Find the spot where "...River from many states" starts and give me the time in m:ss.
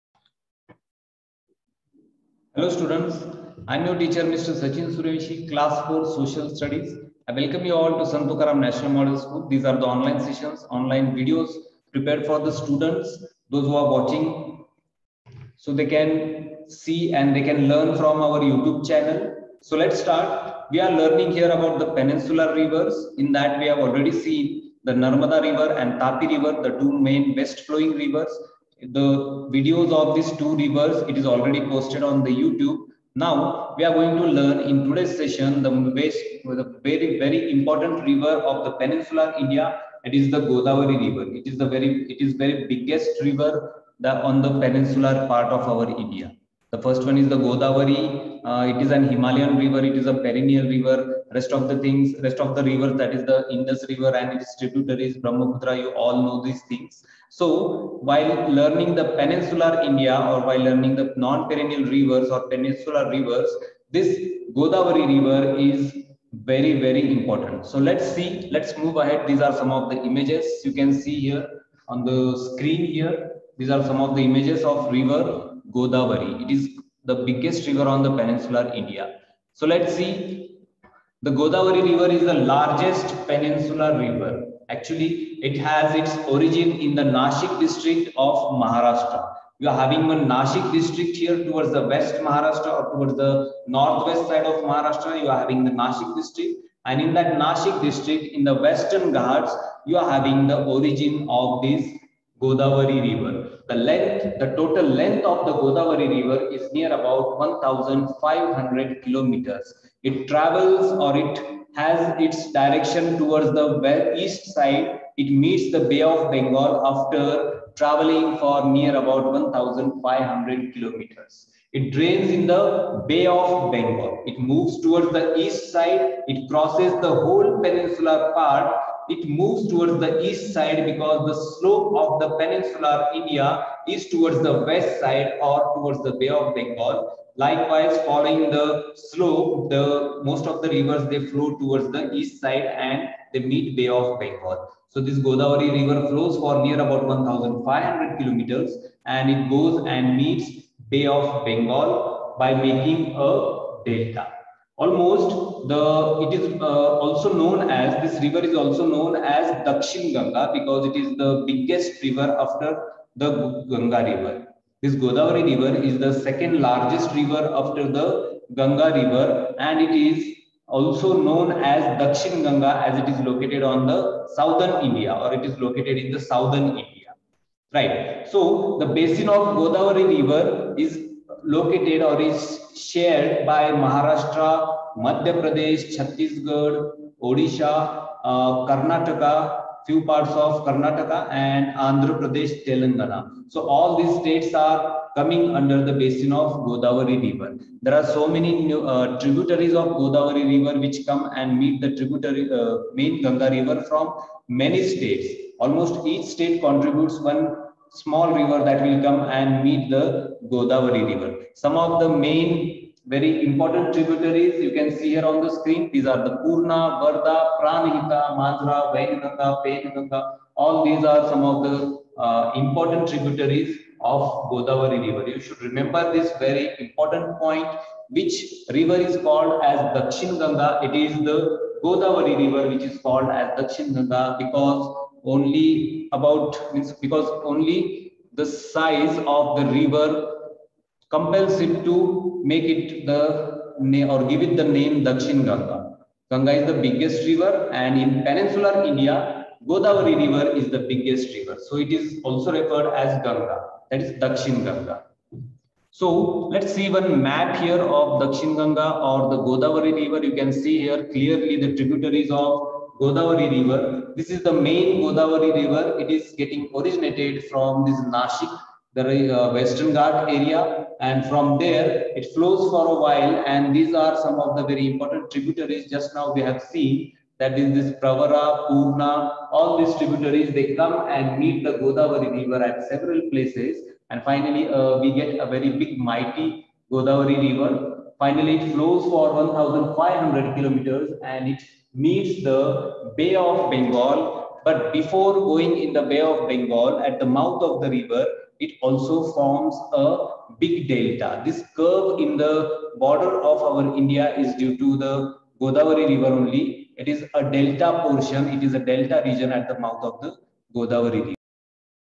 3:23.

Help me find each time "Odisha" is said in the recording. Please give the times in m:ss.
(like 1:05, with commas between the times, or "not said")
3:07.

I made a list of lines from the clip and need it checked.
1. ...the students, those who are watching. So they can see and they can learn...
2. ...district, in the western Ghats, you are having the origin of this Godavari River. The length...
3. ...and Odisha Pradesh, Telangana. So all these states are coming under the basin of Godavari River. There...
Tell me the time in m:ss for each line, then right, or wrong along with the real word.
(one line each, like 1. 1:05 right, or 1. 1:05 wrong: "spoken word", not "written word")
1. 0:12 right
2. 1:37 right
3. 3:11 wrong: "Andhra", not "Odisha".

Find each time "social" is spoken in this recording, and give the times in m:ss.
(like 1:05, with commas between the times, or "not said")
0:06.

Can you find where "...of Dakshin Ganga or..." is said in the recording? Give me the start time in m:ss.
4:17.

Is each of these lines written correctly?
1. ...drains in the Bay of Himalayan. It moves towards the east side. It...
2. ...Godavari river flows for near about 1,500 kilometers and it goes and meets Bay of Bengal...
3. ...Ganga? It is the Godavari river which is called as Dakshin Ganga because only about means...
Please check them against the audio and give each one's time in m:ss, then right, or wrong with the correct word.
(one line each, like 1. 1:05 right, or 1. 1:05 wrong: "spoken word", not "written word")
1. 2:01 wrong: "Bengal", not "Himalayan"
2. 2:25 right
3. 3:50 right.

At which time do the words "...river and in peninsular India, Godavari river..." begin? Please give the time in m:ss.
4:07.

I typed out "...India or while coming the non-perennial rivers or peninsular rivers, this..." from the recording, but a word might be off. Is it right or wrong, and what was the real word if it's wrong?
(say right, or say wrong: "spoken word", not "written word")
wrong: "learning", not "coming".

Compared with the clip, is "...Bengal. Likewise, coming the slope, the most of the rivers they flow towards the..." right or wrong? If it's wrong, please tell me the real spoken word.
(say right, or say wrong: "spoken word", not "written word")
wrong: "following", not "coming".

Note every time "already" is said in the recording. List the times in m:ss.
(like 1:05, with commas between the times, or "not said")
0:23, 0:31.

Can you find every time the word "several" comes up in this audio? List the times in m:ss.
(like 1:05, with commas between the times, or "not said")
4:42.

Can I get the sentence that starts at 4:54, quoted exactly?
But before going in the Bay of Bengal, at the mouth of the river, it also forms a big delta.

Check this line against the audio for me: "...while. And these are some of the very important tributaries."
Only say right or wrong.
right.